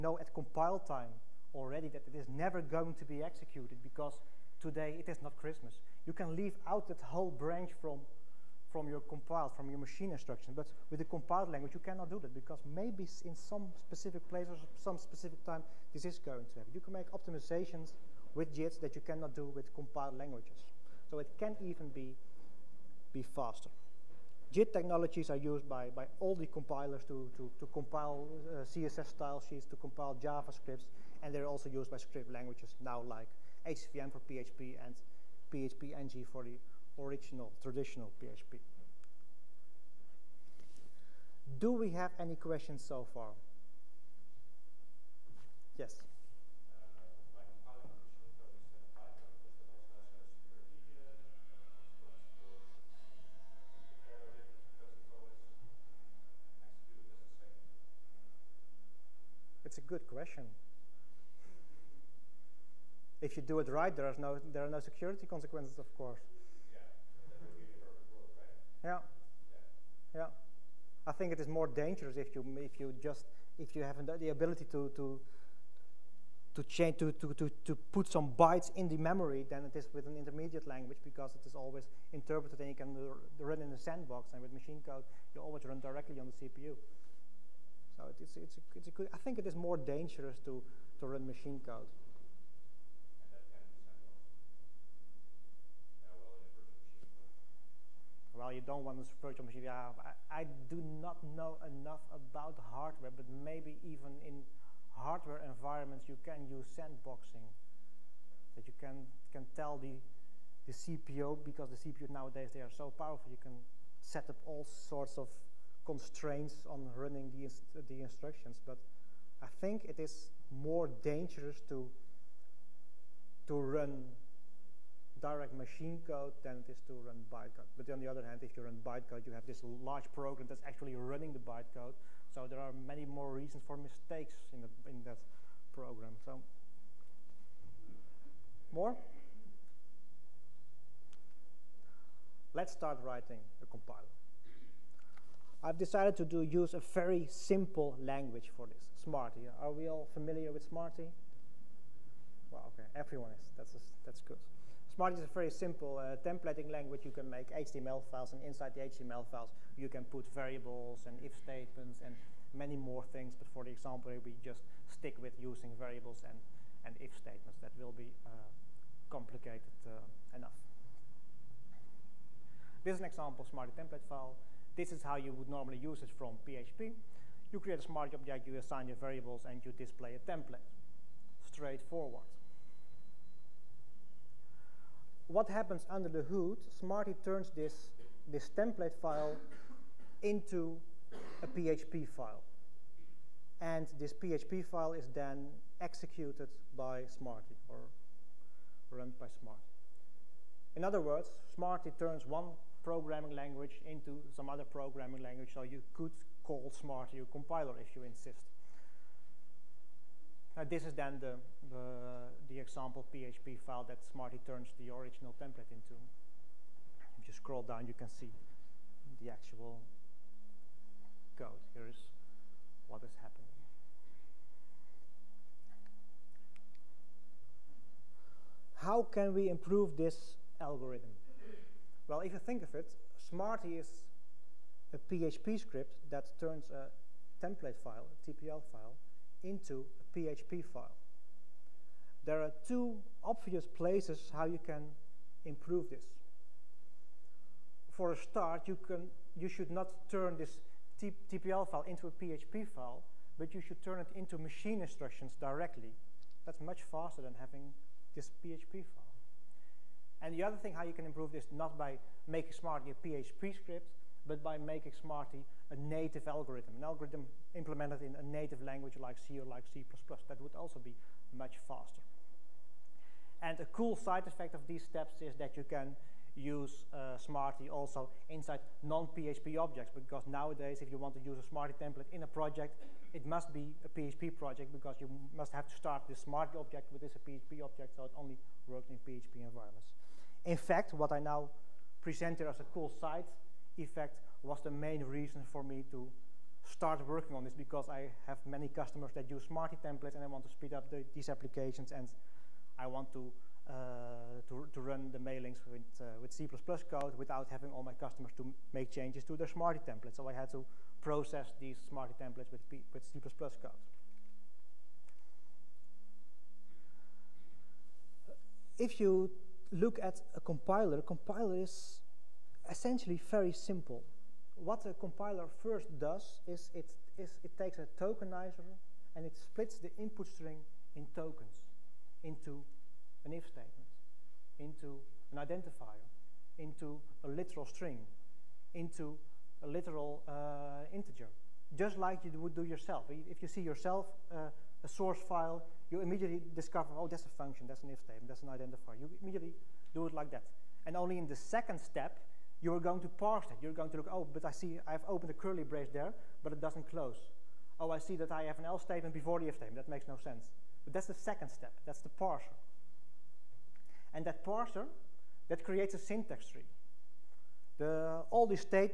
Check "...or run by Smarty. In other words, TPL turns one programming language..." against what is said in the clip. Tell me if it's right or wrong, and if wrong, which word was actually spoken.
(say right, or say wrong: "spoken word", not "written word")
wrong: "Smarty", not "TPL".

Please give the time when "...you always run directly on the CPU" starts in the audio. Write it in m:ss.
1:25.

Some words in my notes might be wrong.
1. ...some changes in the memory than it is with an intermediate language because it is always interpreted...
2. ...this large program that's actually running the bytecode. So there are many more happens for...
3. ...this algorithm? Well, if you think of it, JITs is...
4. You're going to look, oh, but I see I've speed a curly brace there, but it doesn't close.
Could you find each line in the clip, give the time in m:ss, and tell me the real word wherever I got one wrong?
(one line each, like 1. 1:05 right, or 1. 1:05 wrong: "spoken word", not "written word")
1. 1:18 wrong: "bytes", not "changes"
2. 2:09 wrong: "reasons", not "happens"
3. 3:49 wrong: "Smarty", not "JITs"
4. 5:53 wrong: "opened", not "speed".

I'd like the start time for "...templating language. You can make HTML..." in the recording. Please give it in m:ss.
2:36.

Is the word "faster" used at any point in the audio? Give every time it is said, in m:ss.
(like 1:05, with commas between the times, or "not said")
0:23, 4:16, 4:31.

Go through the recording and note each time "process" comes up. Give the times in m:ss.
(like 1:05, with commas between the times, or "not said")
5:11.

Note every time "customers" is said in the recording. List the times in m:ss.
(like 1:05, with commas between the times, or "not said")
4:58, 5:07.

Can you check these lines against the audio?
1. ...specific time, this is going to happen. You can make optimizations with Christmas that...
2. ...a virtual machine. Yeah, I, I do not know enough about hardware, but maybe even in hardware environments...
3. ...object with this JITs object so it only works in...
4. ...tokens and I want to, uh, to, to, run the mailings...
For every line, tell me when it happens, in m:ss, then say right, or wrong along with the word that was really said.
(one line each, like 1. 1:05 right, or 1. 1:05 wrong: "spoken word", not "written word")
1. 0:14 wrong: "JITs", not "Christmas"
2. 1:39 right
3. 4:46 wrong: "PHP", not "JITs"
4. 5:01 wrong: "applications", not "tokens".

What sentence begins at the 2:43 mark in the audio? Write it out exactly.
But for the example, we just stick with using variables and, and if statements.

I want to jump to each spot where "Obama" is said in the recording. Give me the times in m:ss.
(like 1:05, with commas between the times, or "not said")
not said.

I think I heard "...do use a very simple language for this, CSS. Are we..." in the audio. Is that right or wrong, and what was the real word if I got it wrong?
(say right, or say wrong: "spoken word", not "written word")
wrong: "Smarty", not "CSS".